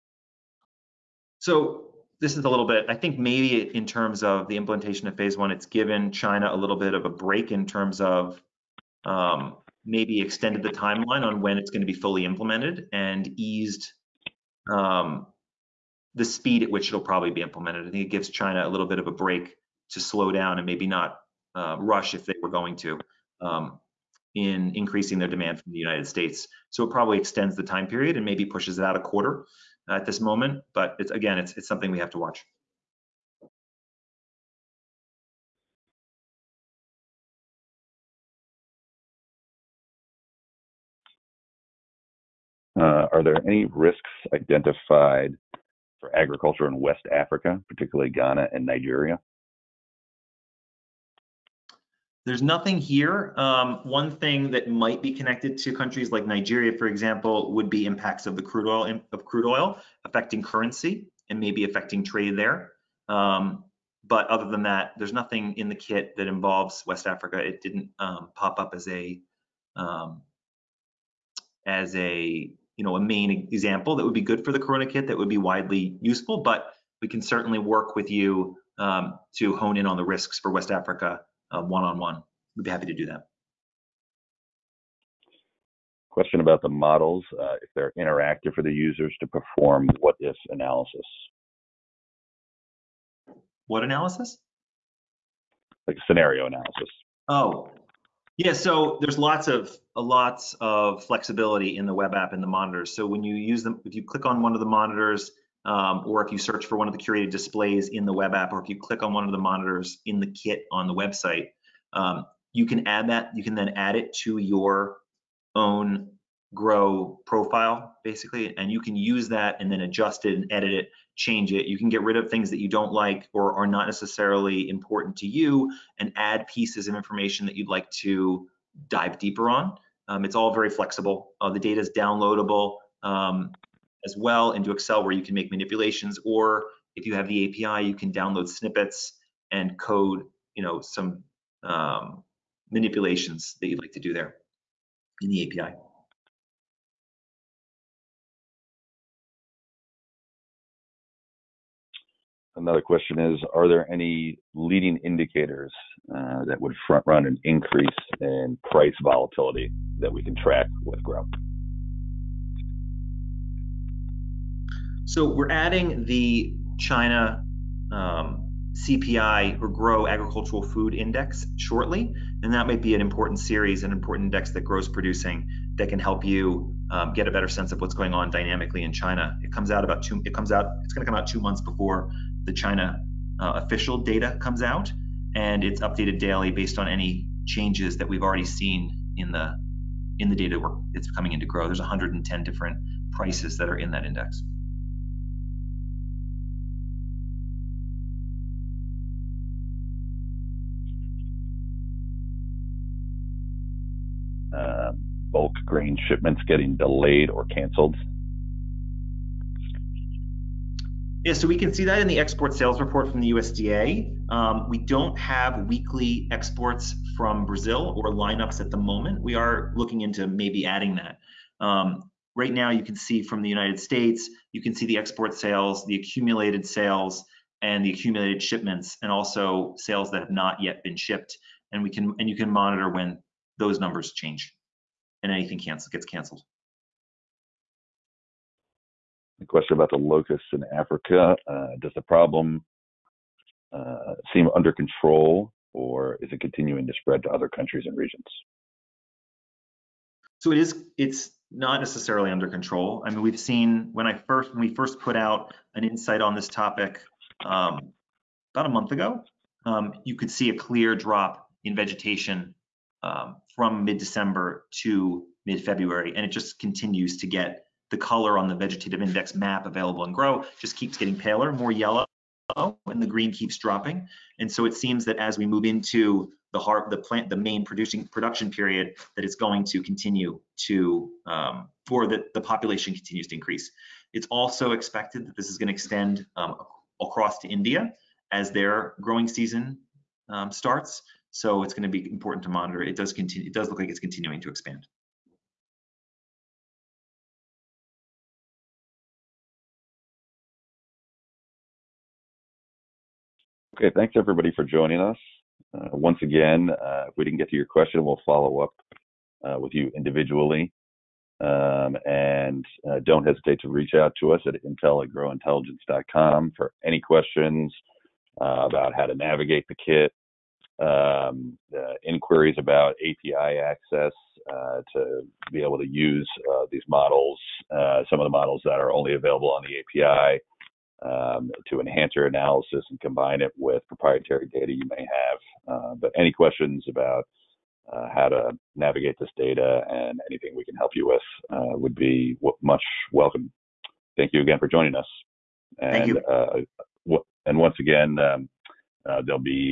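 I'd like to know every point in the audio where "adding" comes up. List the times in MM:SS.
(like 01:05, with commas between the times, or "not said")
02:45, 03:40.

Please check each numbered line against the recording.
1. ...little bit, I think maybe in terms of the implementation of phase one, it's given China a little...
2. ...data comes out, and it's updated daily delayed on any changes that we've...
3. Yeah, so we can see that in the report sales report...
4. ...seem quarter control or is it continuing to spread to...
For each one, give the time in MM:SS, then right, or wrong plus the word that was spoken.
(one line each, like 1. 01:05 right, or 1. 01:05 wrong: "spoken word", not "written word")
1. 00:02 right
2. 03:03 wrong: "based", not "delayed"
3. 03:31 wrong: "export", not "report"
4. 04:04 wrong: "under", not "quarter".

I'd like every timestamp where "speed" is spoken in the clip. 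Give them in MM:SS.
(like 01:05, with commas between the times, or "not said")
00:16.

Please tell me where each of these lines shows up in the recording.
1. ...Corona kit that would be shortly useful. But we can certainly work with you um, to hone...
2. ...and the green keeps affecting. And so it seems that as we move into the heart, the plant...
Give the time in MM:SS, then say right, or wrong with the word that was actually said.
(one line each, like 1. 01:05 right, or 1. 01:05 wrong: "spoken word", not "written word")
1. 01:14 wrong: "widely", not "shortly"
2. 04:32 wrong: "dropping", not "affecting".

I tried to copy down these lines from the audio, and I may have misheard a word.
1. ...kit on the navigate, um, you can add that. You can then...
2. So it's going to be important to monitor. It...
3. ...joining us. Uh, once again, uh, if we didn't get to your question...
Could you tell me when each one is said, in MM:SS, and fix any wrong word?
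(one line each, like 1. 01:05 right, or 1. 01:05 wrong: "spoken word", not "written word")
1. 01:50 wrong: "website", not "navigate"
2. 04:51 right
3. 05:04 right.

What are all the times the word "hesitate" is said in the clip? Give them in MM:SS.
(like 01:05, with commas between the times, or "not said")
05:13.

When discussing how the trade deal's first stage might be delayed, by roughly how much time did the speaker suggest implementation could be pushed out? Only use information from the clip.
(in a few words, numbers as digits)
a quarter.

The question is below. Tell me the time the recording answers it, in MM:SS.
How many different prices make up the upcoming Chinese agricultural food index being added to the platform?
03:11.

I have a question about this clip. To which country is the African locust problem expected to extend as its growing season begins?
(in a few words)
India.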